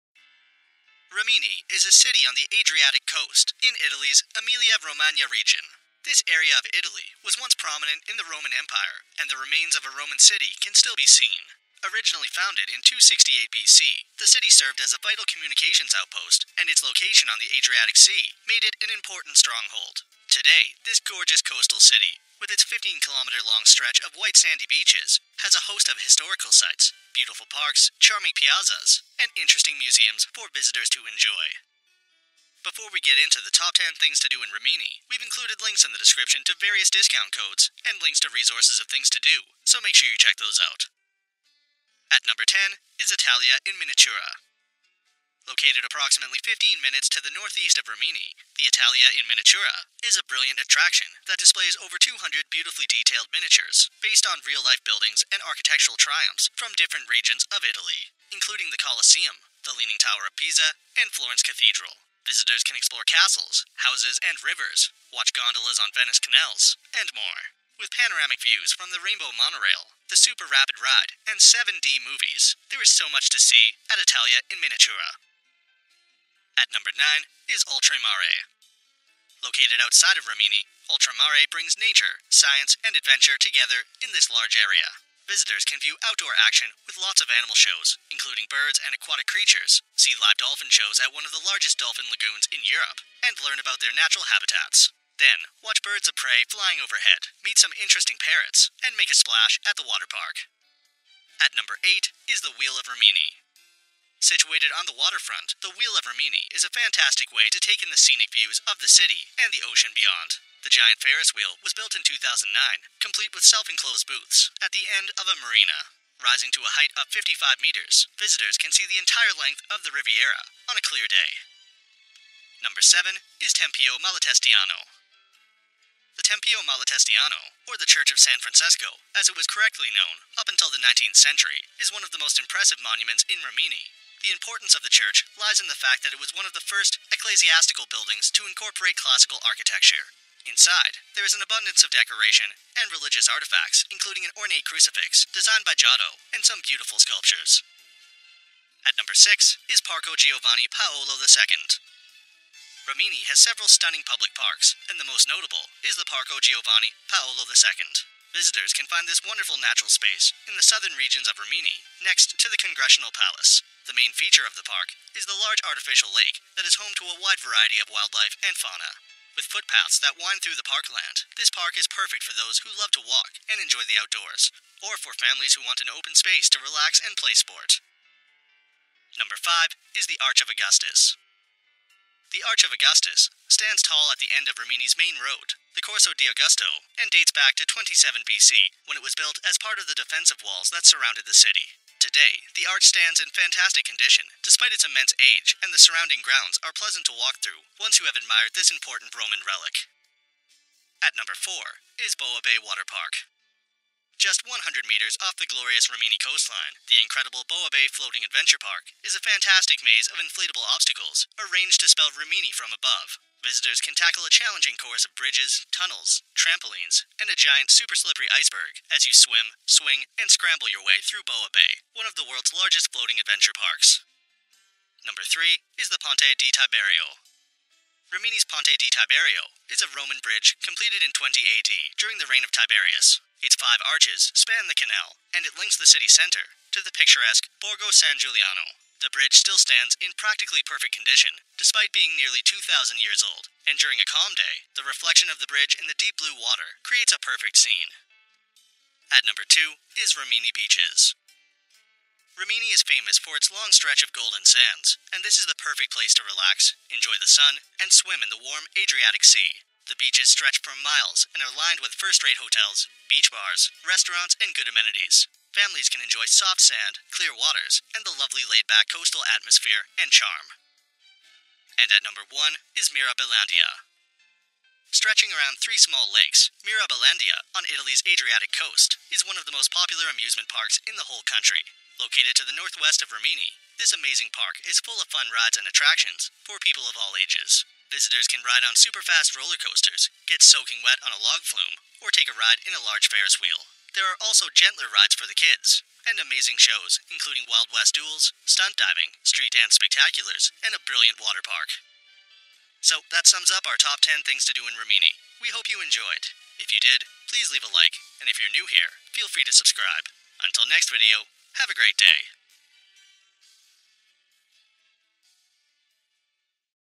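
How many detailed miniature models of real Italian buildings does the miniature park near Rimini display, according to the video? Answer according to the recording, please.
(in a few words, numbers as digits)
over 200.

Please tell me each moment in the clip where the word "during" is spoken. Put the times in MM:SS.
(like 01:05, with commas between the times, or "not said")
03:51, 04:03.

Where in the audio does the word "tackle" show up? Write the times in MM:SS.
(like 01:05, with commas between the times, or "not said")
03:33.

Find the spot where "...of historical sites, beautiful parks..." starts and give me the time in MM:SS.
00:25.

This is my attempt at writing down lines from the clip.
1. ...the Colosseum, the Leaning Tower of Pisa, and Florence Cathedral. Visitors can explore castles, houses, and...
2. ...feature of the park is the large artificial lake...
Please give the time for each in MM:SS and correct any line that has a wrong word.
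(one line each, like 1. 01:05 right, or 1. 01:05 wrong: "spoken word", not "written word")
1. 00:58 right
2. 02:44 right.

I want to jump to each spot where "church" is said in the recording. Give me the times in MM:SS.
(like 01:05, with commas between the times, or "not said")
02:07, 02:14.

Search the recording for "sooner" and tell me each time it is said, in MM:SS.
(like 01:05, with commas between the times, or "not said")
not said.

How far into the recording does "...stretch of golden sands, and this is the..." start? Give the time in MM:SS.
04:13.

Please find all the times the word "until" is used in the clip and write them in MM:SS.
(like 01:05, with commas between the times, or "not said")
02:10, 05:10.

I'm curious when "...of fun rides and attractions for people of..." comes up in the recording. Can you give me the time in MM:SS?
04:44.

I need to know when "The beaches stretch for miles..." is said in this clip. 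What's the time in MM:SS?
04:19.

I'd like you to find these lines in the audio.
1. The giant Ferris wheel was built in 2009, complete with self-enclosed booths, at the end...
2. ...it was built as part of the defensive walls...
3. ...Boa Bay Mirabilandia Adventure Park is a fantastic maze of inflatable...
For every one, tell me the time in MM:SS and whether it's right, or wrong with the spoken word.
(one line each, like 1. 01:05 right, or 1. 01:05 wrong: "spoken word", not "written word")
1. 01:50 right
2. 03:08 right
3. 03:27 wrong: "Floating", not "Mirabilandia".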